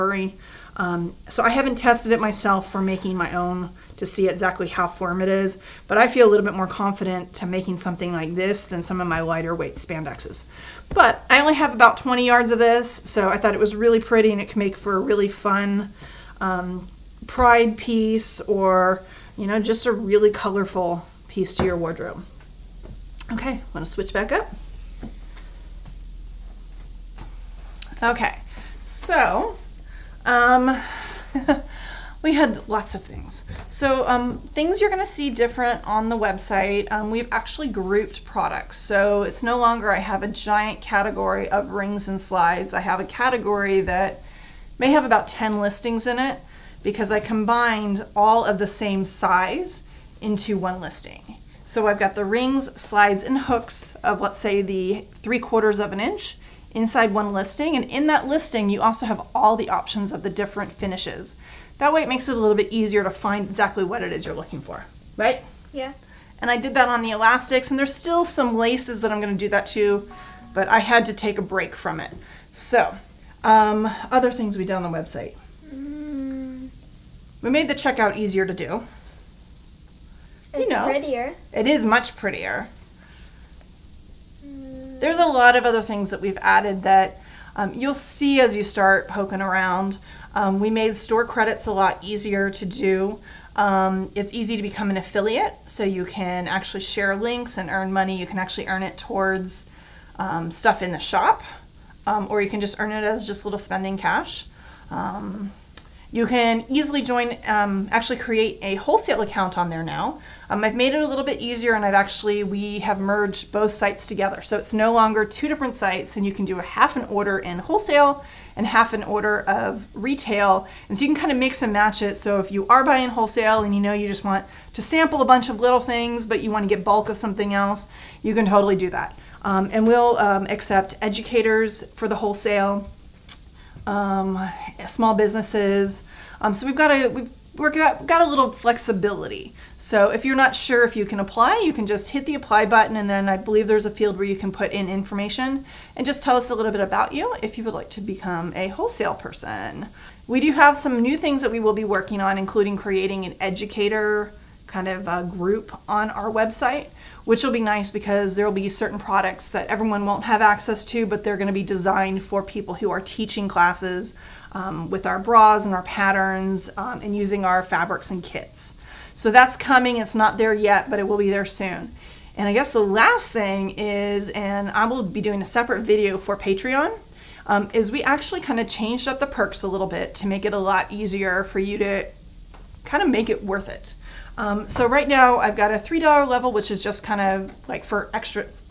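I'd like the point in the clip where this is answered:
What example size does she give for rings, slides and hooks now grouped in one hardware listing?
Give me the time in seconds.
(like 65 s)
55 s.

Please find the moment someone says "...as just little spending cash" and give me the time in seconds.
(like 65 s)
103 s.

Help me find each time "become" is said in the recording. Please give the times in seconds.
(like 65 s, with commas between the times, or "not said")
94 s, 148 s.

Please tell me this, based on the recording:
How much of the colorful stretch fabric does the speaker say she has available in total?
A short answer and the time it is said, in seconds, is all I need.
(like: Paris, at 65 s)
20 yards, at 11 s.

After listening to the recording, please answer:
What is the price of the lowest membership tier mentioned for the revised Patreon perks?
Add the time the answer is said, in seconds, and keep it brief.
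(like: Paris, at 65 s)
$3, at 185 s.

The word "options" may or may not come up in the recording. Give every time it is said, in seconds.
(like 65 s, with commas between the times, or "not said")
59 s.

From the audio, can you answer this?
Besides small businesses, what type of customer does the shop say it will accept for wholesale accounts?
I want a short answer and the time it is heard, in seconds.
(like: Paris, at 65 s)
Educators, at 131 s.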